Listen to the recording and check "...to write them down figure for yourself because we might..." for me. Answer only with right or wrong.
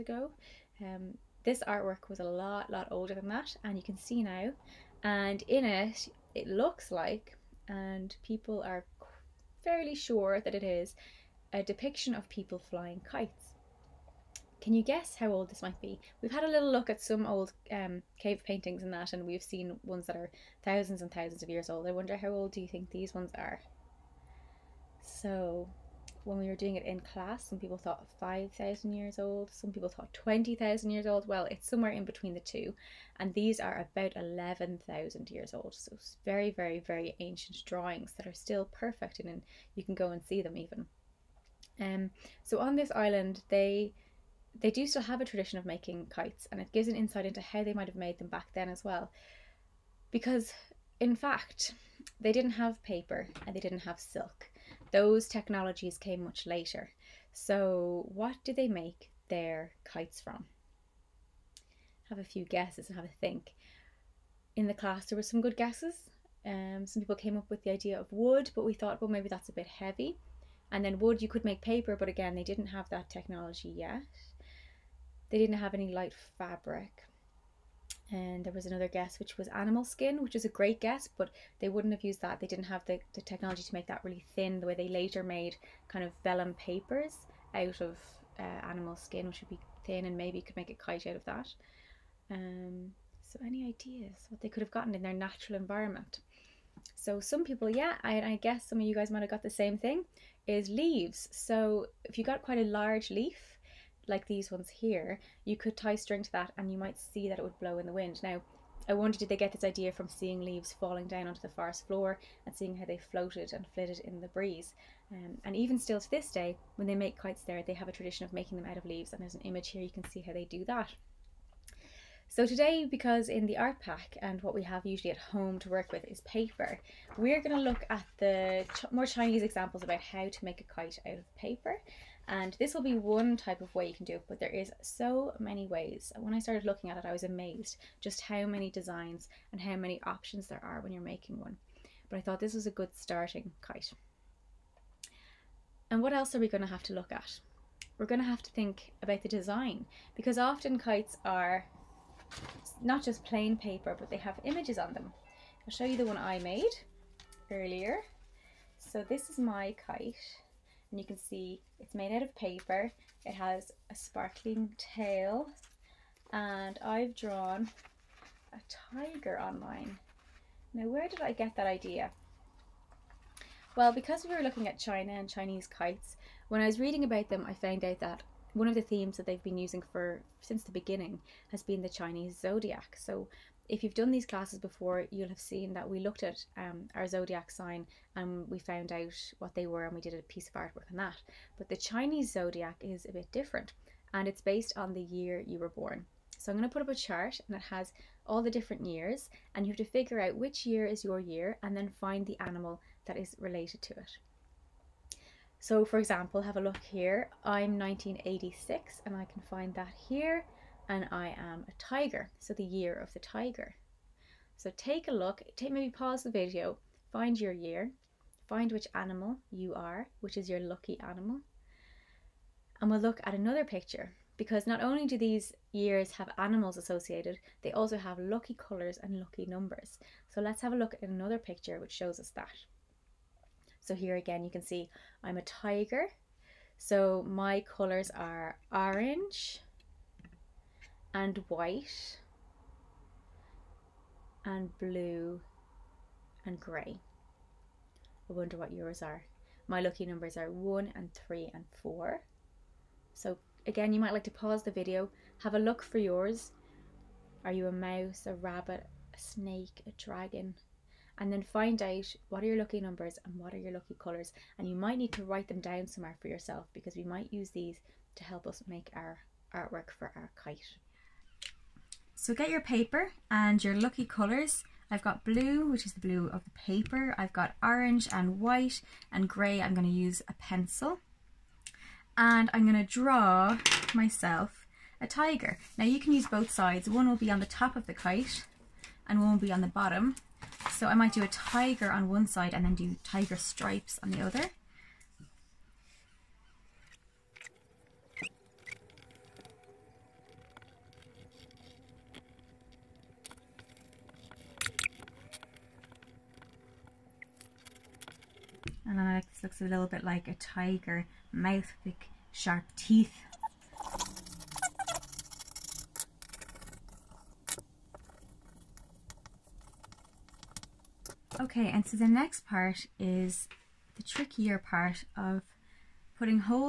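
wrong.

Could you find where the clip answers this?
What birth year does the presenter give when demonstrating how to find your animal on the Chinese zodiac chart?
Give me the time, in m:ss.
3:27.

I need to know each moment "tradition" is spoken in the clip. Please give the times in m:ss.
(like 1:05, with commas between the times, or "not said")
0:45, 1:57.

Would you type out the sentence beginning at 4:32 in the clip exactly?
So get your paper and your lucky colors.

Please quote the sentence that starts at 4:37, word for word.
I've got orange and white and grey.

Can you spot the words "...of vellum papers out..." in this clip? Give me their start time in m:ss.
1:26.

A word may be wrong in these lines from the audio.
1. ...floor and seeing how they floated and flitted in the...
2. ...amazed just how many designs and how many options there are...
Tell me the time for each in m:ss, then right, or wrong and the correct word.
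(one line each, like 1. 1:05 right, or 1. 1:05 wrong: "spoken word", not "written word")
1. 1:51 right
2. 2:17 right.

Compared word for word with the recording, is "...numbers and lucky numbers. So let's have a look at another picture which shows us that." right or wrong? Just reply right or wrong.
wrong.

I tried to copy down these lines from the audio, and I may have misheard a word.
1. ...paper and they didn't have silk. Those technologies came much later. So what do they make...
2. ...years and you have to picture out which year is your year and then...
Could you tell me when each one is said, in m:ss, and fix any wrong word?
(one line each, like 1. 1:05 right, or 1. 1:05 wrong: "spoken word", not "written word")
1. 0:52 right
2. 3:18 wrong: "figure", not "picture".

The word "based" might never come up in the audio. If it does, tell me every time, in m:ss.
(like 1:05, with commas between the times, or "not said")
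3:14.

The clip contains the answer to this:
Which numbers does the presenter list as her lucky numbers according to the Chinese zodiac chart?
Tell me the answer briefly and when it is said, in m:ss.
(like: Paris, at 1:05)
1, 3 and 4, at 4:10.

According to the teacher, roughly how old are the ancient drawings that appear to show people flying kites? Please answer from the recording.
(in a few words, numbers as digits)
11,000 years.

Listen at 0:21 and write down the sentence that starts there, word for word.
I wonder how old do you think these ones are?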